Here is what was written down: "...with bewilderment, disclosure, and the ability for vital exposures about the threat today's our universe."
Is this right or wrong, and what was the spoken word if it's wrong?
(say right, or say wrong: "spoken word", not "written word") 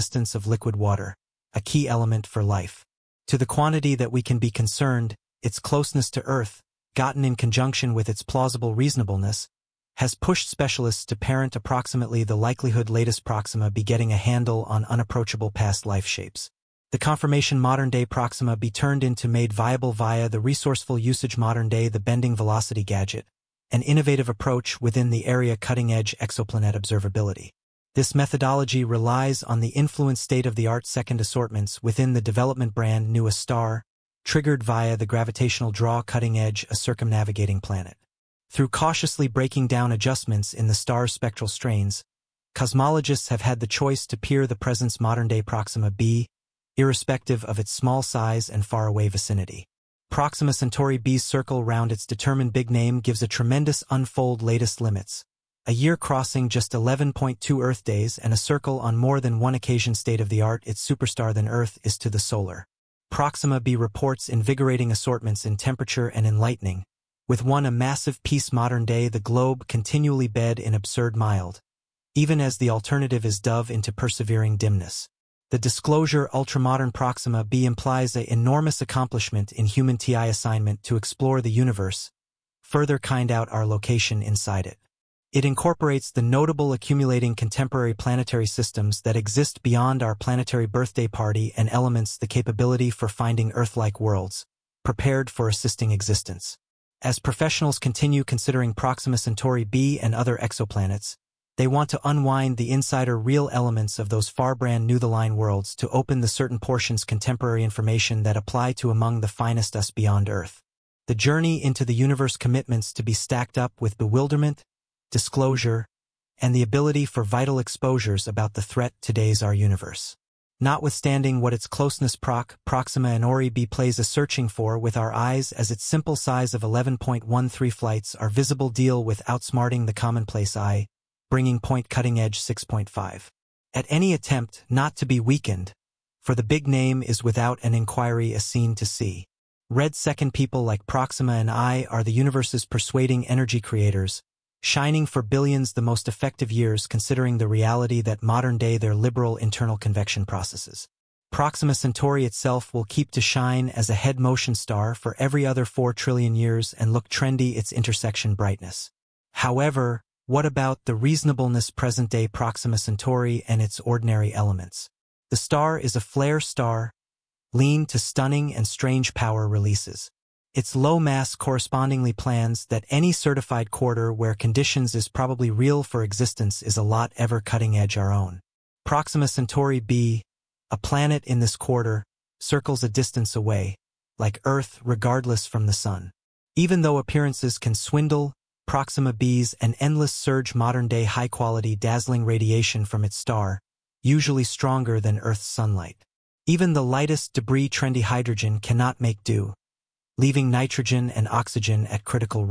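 right.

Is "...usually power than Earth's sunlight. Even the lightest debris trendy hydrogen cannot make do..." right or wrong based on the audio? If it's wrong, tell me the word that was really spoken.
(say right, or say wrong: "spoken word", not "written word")
wrong: "stronger", not "power".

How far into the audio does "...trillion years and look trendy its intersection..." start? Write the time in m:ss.
2:35.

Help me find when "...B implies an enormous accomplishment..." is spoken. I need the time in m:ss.
1:17.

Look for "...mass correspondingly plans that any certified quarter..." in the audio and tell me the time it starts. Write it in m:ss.
2:50.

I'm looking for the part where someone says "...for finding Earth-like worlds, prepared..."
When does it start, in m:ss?
1:32.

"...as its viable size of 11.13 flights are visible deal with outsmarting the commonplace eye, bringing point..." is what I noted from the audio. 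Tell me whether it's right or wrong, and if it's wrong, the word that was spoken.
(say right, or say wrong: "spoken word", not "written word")
wrong: "simple", not "viable".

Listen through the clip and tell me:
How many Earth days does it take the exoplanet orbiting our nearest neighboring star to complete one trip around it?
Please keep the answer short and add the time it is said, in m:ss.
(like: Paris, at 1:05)
11.2 Earth days, at 0:56.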